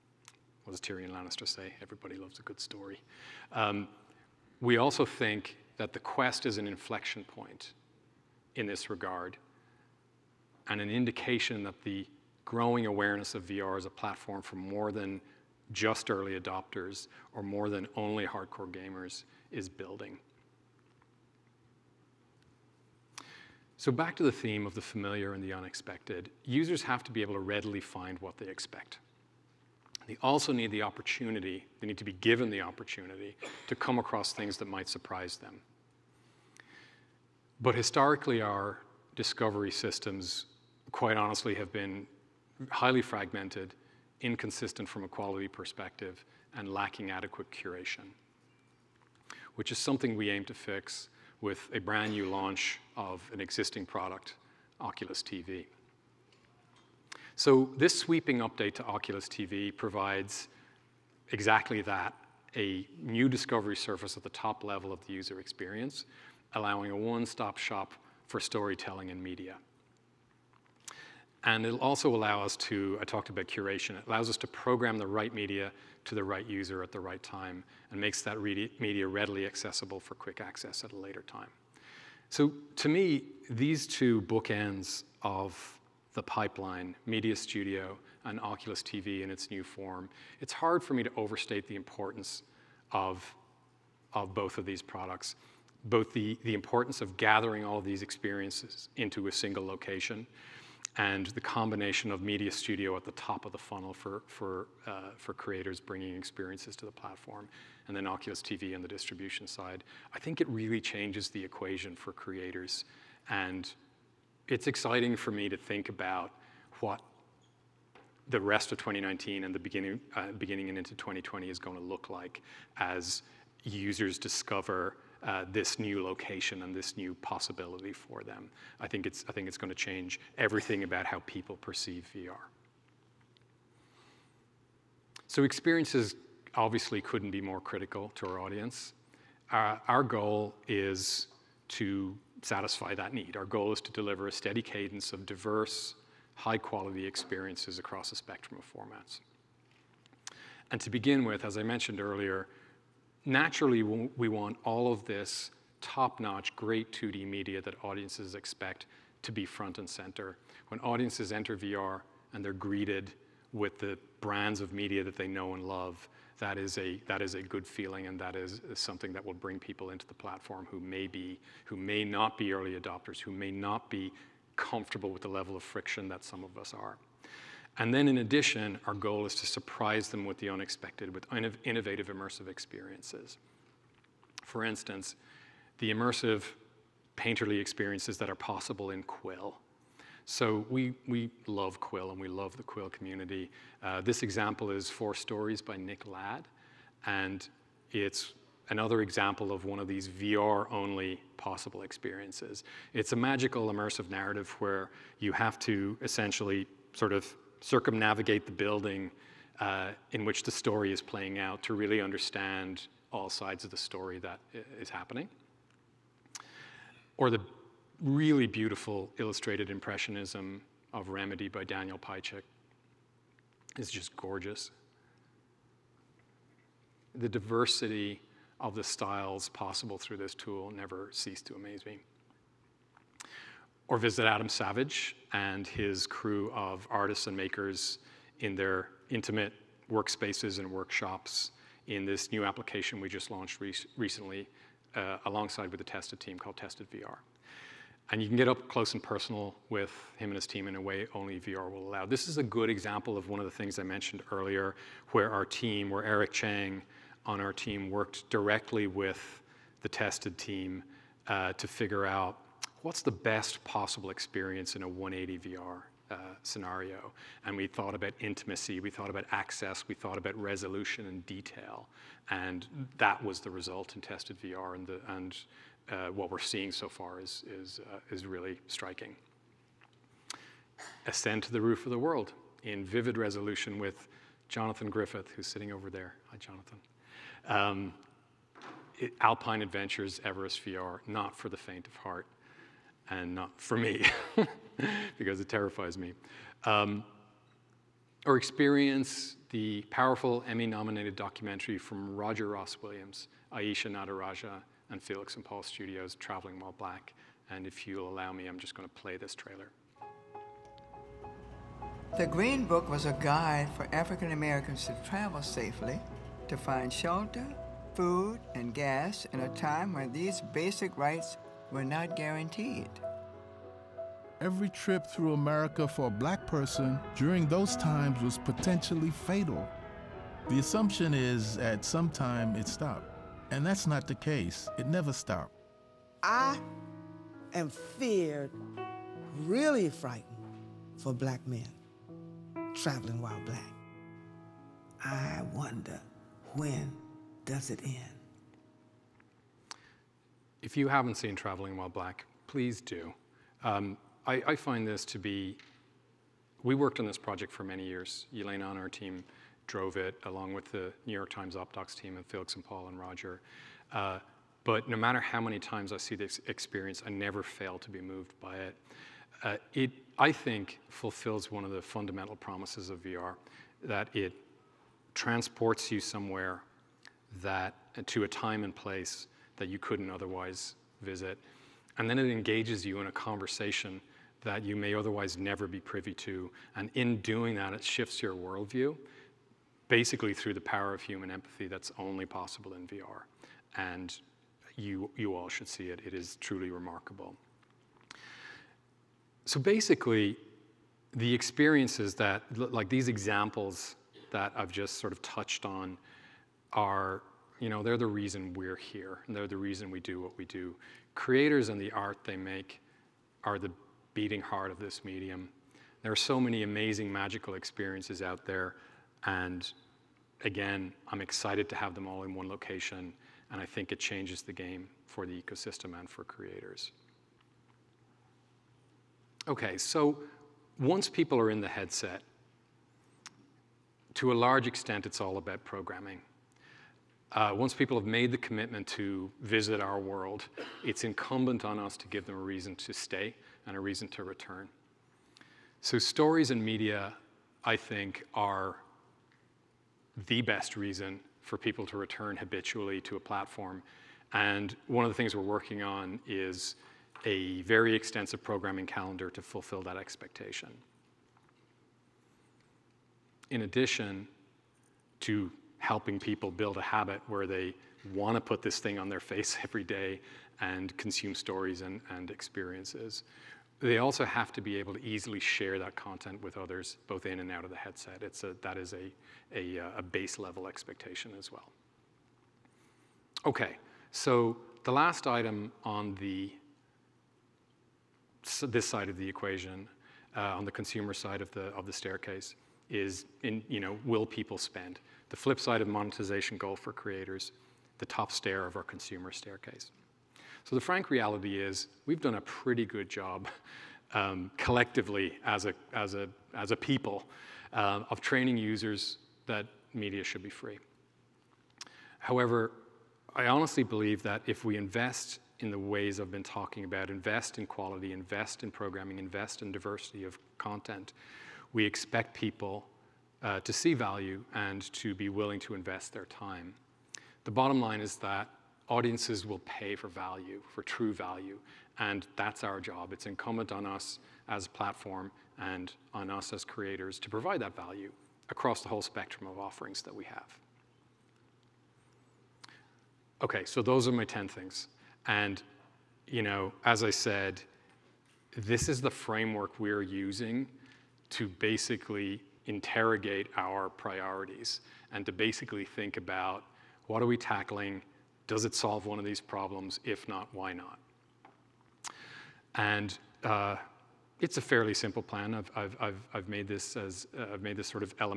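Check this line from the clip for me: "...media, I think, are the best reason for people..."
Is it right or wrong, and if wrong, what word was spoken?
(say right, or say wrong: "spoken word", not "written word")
right.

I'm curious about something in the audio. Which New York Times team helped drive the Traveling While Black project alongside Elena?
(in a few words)
OpDocs.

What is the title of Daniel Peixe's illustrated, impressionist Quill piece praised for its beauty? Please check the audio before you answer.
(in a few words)
Remedy.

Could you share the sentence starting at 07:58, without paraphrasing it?
It's a, that is a, a, uh, a base level expectation as well.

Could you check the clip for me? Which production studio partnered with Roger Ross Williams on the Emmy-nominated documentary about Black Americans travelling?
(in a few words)
Felix and Paul Studios.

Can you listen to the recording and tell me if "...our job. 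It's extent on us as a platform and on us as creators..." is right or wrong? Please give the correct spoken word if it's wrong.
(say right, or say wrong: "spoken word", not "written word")
wrong: "incumbent", not "extent".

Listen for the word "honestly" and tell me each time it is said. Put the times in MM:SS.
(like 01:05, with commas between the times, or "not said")
00:41, 08:33.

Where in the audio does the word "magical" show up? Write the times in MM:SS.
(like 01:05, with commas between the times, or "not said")
03:23, 06:57.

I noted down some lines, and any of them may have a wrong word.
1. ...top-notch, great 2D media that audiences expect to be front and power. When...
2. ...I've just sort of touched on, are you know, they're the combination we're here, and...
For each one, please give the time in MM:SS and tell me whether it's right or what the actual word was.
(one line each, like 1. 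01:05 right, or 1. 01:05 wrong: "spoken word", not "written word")
1. 02:35 wrong: "center", not "power"
2. 06:44 wrong: "reason", not "combination".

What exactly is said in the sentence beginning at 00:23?
So back to the theme of the familiar and the unexpected, users have to be able to readily find what they expect.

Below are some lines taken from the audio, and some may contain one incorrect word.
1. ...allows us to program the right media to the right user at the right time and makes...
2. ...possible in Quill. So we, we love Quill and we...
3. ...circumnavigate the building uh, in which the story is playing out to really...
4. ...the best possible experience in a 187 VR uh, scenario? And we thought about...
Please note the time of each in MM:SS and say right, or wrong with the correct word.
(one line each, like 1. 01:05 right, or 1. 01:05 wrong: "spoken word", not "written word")
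1. 01:14 right
2. 03:08 right
3. 03:27 right
4. 04:23 wrong: "180", not "187".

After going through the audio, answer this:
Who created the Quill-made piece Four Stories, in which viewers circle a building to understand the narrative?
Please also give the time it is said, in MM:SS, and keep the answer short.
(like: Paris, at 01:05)
Nick Ladd, at 03:15.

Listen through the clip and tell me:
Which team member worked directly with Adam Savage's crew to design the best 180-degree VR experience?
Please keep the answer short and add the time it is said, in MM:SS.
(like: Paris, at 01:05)
Eric Chang, at 04:16.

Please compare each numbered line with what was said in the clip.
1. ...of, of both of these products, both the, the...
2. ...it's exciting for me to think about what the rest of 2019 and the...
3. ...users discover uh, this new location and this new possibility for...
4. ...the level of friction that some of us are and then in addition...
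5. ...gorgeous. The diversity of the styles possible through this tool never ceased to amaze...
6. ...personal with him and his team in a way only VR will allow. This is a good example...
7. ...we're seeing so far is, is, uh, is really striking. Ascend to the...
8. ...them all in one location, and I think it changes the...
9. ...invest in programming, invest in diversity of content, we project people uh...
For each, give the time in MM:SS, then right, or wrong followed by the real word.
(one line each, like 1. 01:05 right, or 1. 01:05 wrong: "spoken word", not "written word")
1. 01:32 right
2. 01:54 right
3. 02:03 right
4. 02:55 right
5. 03:44 right
6. 04:09 right
7. 04:36 right
8. 07:01 right
9. 08:38 wrong: "expect", not "project".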